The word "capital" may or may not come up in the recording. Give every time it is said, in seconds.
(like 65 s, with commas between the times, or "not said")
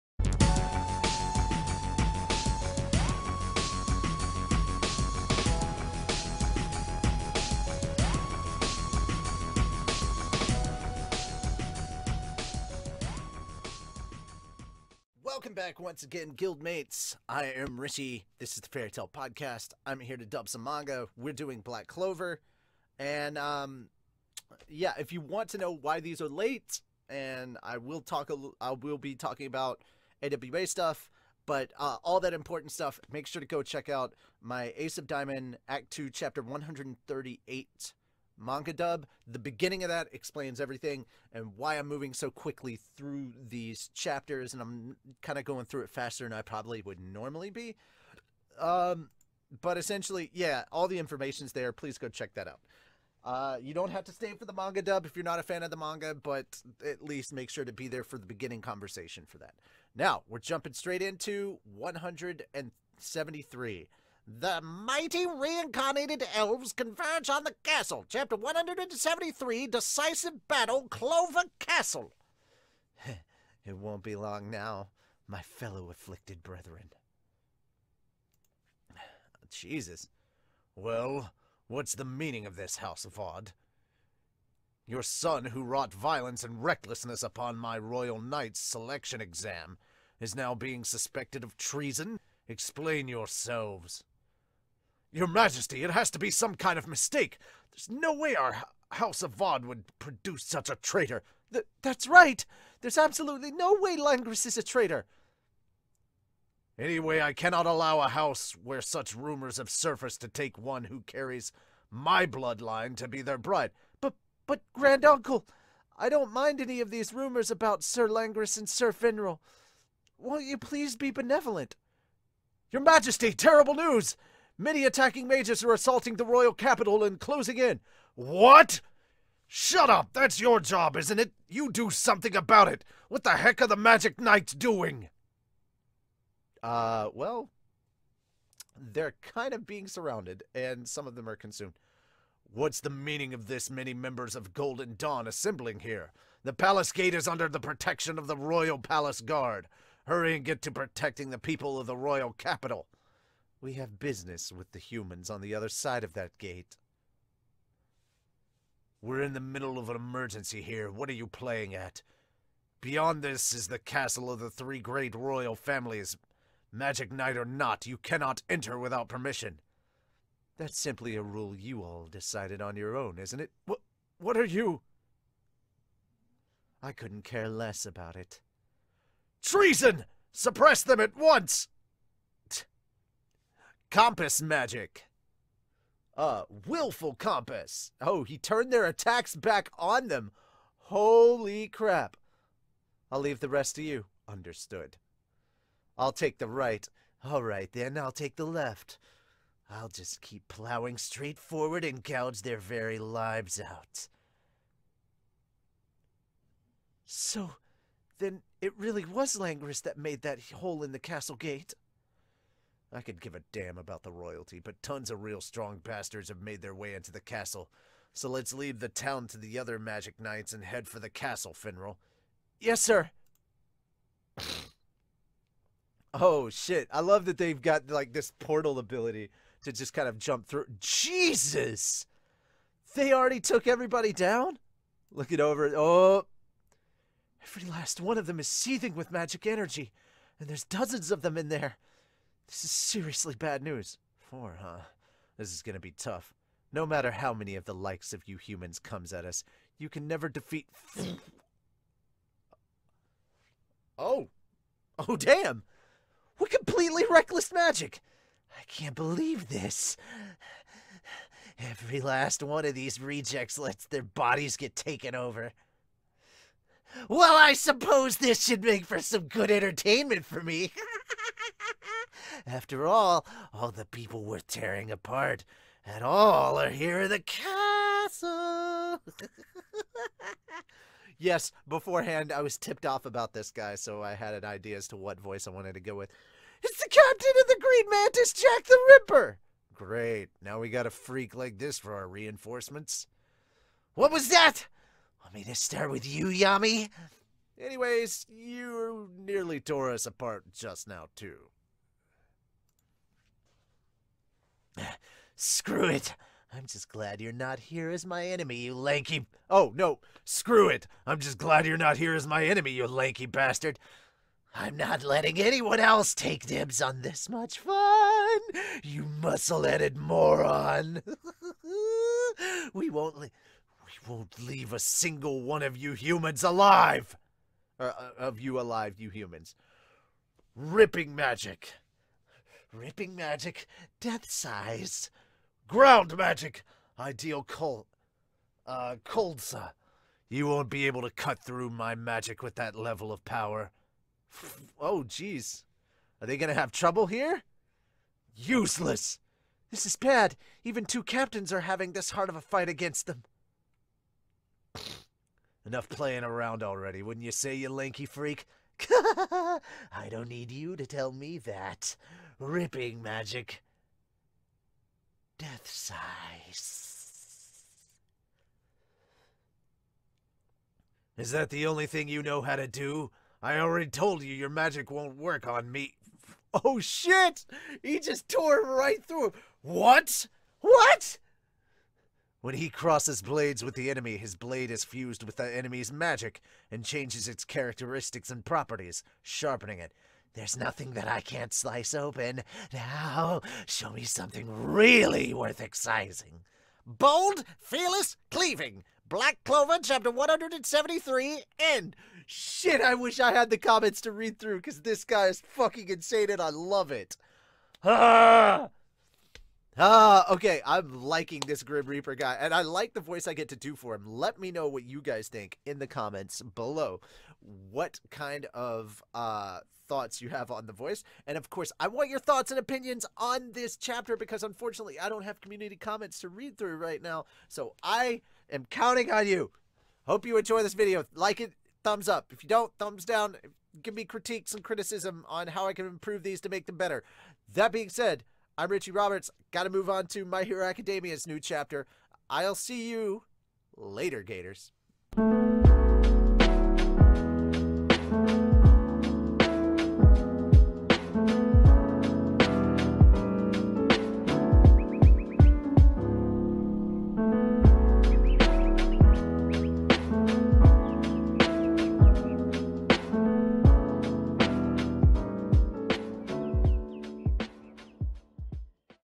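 126 s, 152 s.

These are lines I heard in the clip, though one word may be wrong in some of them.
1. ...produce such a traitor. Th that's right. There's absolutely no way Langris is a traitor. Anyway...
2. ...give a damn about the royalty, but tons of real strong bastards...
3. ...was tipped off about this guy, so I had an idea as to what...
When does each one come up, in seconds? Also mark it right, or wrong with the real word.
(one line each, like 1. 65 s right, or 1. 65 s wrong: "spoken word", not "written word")
1. 99 s right
2. 213 s right
3. 282 s right.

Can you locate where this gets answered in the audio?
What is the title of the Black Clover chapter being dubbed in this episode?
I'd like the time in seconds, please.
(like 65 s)
69 s.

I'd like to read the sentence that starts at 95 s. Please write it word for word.
Your Majesty, it has to be some kind of mistake.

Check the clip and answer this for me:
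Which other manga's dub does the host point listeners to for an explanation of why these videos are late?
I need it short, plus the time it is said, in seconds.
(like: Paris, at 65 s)
Ace of Diamond Act 2 Chapter 138, at 34 s.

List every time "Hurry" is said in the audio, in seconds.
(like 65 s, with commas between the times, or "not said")
150 s.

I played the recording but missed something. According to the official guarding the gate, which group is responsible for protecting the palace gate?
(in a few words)
Royal Palace Guard.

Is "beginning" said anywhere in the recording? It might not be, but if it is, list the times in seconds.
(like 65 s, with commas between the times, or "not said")
39 s, 58 s.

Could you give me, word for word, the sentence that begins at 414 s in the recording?
Let me know what you guys think in the comments below.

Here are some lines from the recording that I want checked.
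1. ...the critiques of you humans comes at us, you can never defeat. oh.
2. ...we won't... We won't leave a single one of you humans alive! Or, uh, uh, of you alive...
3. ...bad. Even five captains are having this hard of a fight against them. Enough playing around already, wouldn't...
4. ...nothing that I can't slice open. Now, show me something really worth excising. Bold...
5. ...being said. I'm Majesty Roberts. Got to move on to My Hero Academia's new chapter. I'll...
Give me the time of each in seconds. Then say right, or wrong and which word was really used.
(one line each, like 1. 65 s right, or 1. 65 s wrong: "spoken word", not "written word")
1. 247 s wrong: "likes", not "critiques"
2. 322 s right
3. 349 s wrong: "two", not "five"
4. 390 s right
5. 437 s wrong: "Richie", not "Majesty".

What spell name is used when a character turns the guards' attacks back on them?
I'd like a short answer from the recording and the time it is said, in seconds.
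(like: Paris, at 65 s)
Willful compass, at 186 s.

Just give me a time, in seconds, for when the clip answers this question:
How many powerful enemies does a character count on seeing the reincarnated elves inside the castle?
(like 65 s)
244 s.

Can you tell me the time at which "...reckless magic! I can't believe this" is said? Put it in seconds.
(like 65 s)
257 s.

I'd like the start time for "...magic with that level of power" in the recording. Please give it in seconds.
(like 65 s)
341 s.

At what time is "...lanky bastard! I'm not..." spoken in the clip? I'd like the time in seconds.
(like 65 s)
312 s.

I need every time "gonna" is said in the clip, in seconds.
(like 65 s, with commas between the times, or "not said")
245 s, 346 s.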